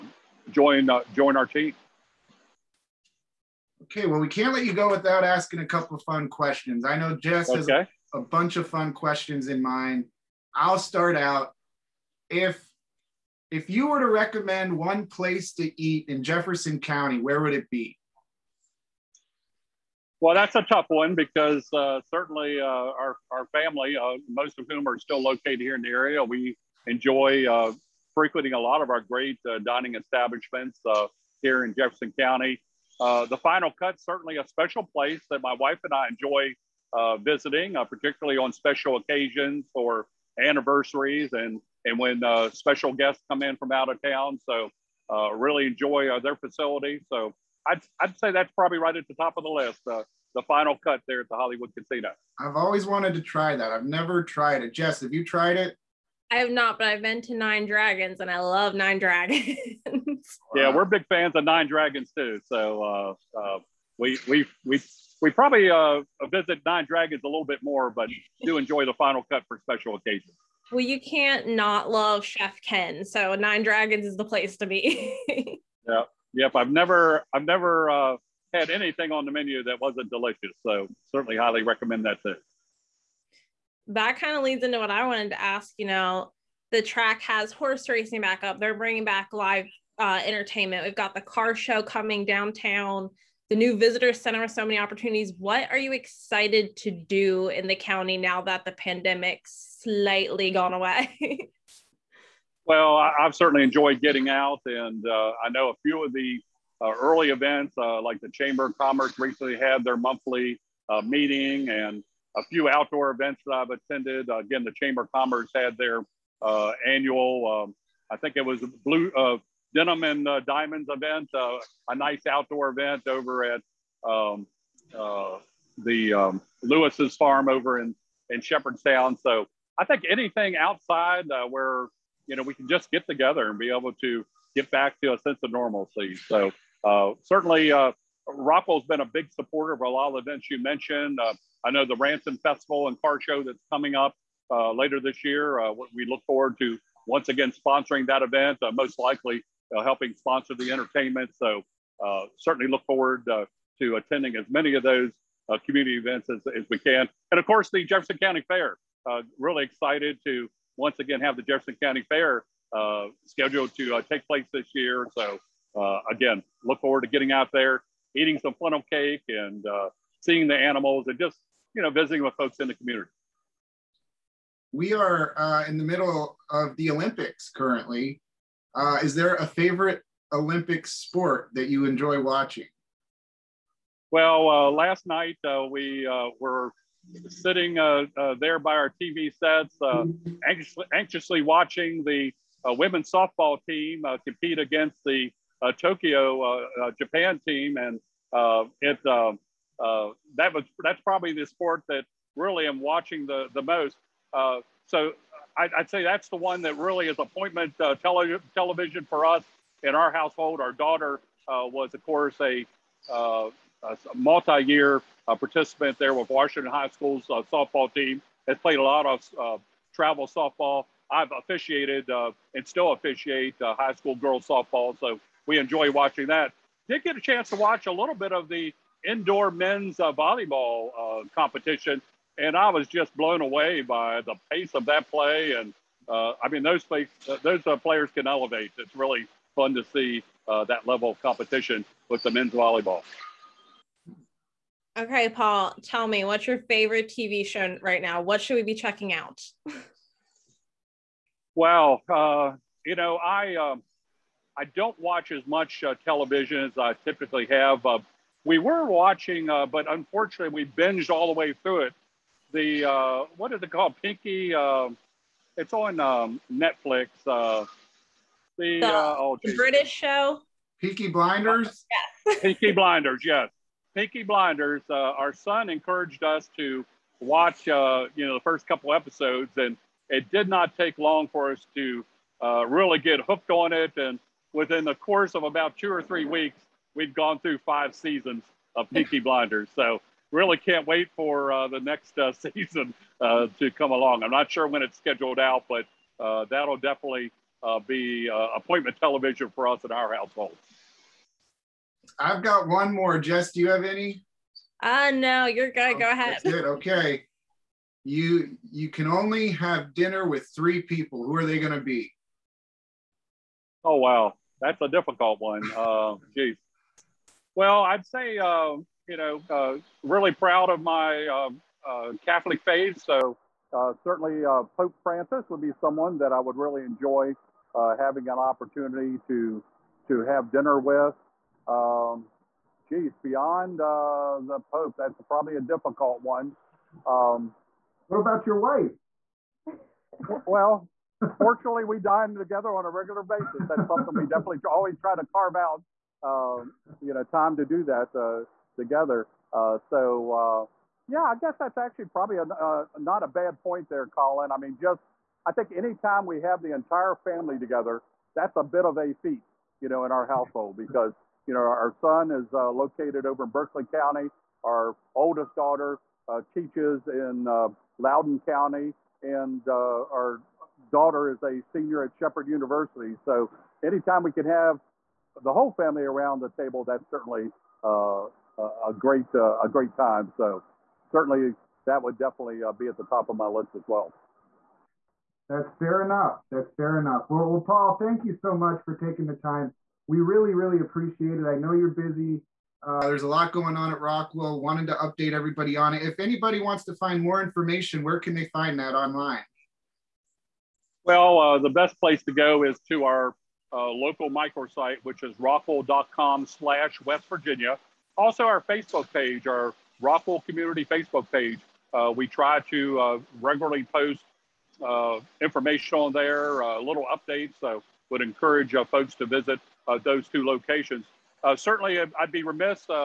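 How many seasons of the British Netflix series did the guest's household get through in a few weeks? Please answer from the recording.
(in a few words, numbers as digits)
5.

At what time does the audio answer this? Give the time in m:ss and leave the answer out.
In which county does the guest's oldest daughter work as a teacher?
6:07.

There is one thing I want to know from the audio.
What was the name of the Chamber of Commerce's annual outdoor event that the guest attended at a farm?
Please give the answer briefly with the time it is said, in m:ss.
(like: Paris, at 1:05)
Blue Denim and Diamonds, at 1:58.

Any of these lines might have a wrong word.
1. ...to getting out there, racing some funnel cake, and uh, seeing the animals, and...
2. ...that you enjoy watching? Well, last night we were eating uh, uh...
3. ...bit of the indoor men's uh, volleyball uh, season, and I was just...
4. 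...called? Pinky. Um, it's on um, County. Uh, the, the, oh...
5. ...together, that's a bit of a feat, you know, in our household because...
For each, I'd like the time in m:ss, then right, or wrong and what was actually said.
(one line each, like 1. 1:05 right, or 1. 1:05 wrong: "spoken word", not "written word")
1. 2:47 wrong: "eating", not "racing"
2. 3:01 wrong: "sitting", not "eating"
3. 3:48 wrong: "competition", not "season"
4. 4:23 wrong: "Netflix", not "County"
5. 5:57 right.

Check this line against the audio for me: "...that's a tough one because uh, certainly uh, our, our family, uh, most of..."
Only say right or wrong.
right.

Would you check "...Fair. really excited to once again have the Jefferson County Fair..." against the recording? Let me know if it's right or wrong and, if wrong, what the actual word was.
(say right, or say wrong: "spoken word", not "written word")
right.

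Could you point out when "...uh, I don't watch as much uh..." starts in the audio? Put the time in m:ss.
4:13.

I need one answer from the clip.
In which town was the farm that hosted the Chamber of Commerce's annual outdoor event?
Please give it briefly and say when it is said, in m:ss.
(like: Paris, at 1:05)
Shepherdstown, at 2:08.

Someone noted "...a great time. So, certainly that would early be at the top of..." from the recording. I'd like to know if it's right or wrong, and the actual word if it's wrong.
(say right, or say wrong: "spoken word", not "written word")
wrong: "definitely", not "early".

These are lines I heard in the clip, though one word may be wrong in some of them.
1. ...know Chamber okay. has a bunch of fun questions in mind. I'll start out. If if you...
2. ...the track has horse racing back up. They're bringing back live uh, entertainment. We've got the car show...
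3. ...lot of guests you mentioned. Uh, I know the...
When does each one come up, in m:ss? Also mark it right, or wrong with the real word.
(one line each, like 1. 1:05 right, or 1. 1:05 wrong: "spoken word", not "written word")
1. 0:06 wrong: "Jess", not "Chamber"
2. 1:26 right
3. 2:19 wrong: "events", not "guests".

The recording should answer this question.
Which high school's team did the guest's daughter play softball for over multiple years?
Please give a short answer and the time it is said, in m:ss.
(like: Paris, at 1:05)
Washington High School, at 3:36.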